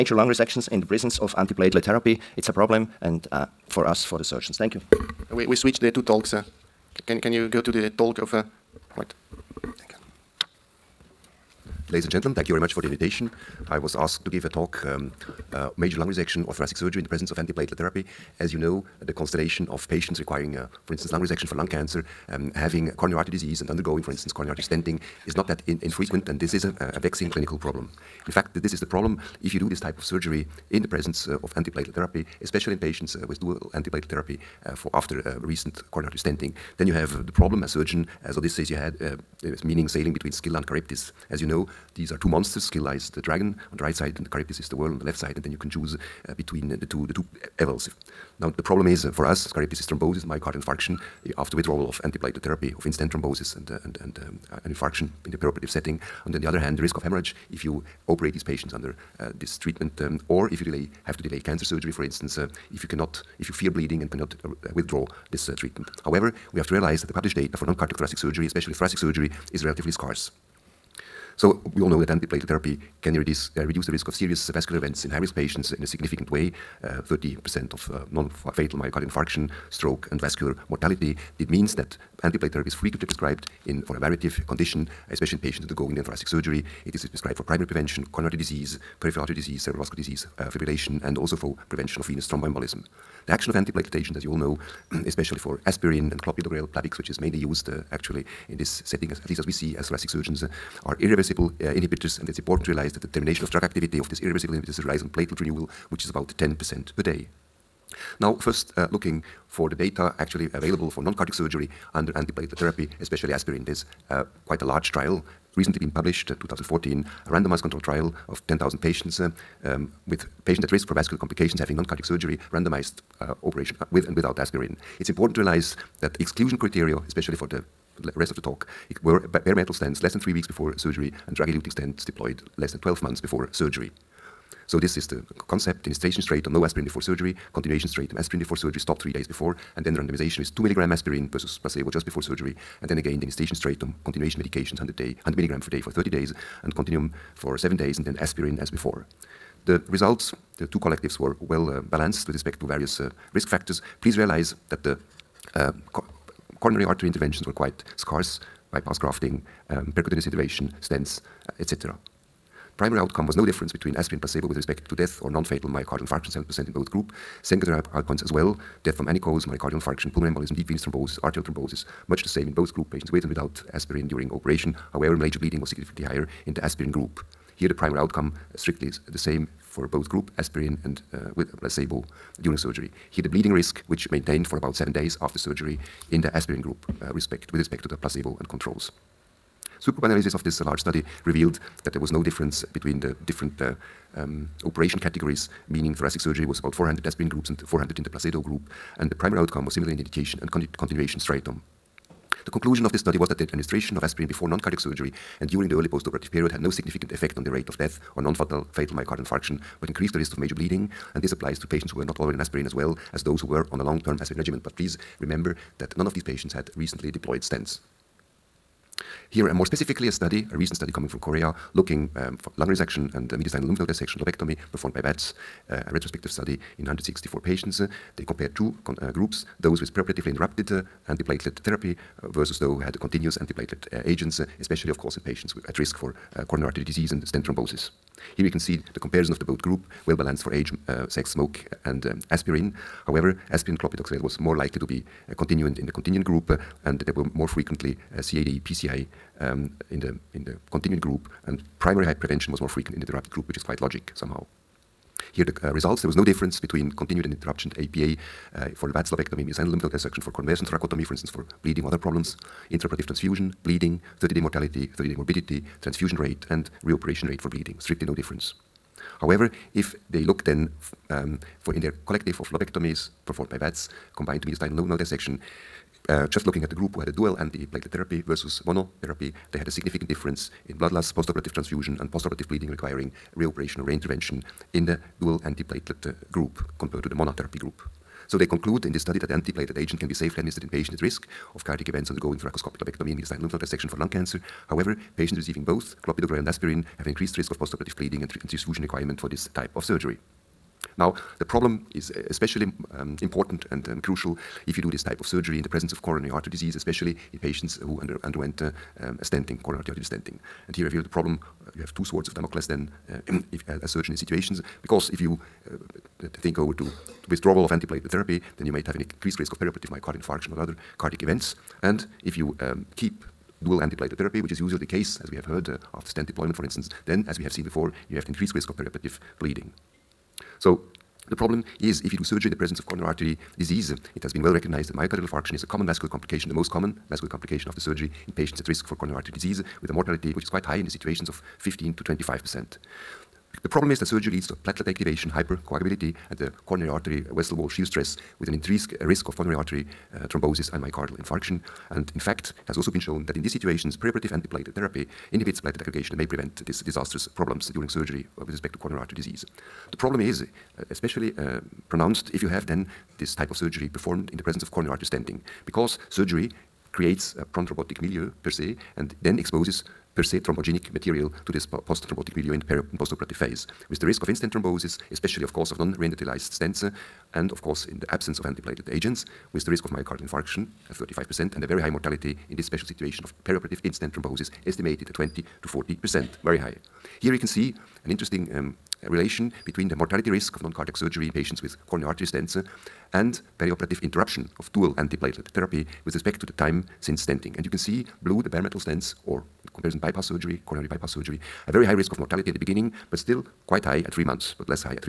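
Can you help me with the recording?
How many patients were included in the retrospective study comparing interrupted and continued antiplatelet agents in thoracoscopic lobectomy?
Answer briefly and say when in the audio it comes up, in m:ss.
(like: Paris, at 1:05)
164, at 3:46.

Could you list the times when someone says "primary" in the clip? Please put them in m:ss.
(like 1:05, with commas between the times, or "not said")
1:27, 2:42, 2:57, 3:19, 4:11.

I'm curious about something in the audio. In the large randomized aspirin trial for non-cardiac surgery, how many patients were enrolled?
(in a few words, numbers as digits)
10,000.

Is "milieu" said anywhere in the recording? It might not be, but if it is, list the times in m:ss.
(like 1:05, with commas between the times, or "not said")
6:07, 6:12.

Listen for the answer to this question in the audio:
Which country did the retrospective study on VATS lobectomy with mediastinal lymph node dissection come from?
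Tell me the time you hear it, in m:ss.
3:41.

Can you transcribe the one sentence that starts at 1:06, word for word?
However, we have to realize that the published data for non-cardiac thoracic surgery, especially thoracic surgery, is relatively scarce.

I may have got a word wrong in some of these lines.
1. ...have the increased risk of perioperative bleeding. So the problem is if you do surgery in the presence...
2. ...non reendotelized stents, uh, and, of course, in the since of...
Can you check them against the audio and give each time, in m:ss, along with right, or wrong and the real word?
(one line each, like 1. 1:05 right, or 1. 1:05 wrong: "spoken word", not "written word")
1. 5:28 right
2. 6:15 wrong: "absence", not "since".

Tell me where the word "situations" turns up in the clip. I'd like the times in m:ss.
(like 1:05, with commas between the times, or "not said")
5:14, 5:40, 5:53, 6:22.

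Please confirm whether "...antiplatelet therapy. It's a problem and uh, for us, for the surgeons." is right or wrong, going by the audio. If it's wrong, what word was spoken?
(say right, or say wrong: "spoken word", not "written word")
right.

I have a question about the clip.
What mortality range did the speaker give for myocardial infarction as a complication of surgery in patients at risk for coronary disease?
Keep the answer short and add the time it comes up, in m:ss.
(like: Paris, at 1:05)
15 to 25 percent, at 5:41.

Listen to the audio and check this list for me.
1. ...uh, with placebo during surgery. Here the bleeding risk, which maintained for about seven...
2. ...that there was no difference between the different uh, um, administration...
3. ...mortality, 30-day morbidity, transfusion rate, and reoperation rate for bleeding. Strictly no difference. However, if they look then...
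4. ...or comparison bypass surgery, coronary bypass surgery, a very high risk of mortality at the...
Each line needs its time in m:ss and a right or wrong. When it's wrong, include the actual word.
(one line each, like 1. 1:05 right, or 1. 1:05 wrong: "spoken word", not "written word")
1. 3:01 right
2. 3:11 wrong: "operation", not "administration"
3. 4:24 right
4. 6:39 right.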